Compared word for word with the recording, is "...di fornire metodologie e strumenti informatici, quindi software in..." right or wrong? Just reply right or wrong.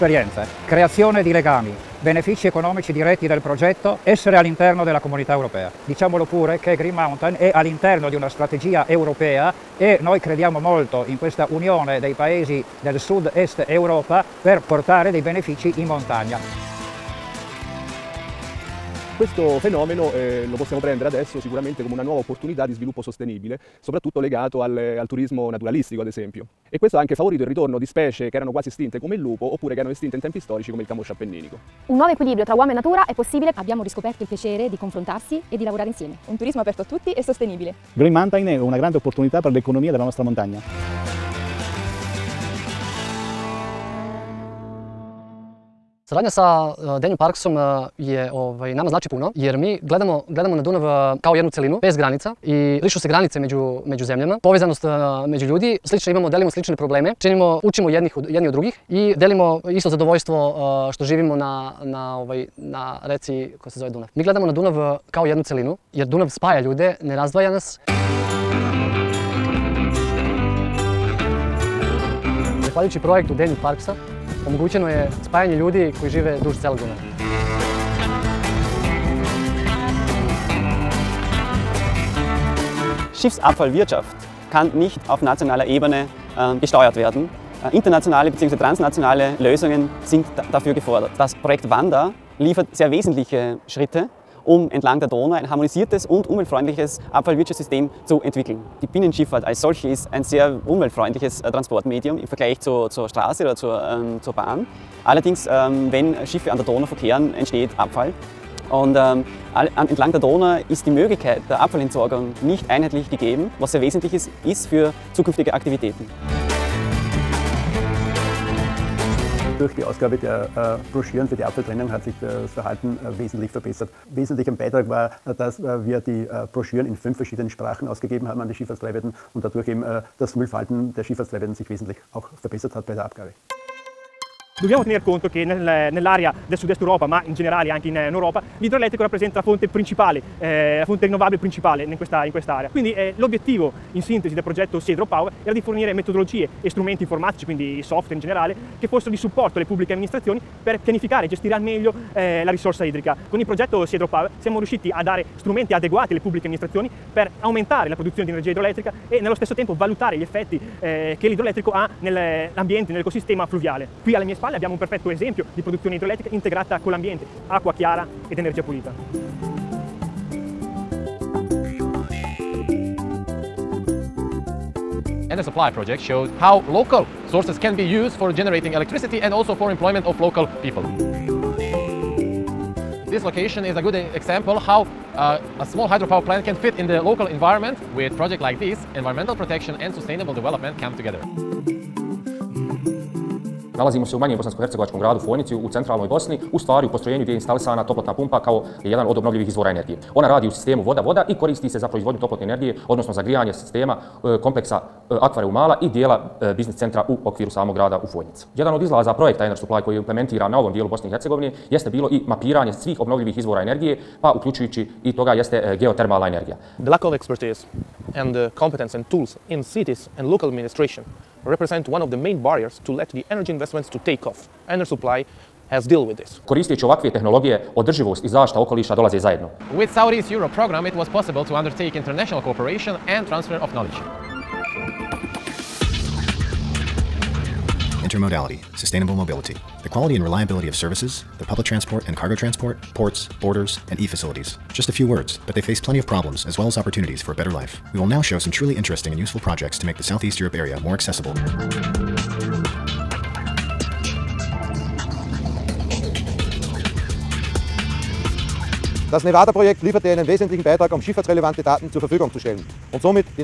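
right.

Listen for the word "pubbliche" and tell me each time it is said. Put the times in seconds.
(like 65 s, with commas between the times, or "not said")
149 s, 156 s.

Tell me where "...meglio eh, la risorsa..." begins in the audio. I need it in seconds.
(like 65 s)
151 s.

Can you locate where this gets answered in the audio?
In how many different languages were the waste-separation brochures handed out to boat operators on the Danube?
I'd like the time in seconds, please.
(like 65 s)
126 s.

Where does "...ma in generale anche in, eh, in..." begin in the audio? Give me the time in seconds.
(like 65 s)
137 s.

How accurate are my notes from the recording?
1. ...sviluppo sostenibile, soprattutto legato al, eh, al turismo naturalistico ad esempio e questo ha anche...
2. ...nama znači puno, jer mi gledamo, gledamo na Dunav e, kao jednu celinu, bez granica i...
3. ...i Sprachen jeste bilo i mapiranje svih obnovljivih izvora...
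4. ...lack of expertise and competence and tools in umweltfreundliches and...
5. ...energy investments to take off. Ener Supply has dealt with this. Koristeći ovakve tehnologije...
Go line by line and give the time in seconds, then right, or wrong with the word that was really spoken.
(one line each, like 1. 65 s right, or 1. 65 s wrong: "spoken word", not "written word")
1. 22 s right
2. 48 s right
3. 211 s wrong: "Hercegovine", not "Sprachen"
4. 216 s wrong: "cities", not "umweltfreundliches"
5. 223 s right.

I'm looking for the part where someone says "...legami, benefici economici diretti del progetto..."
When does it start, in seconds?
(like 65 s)
1 s.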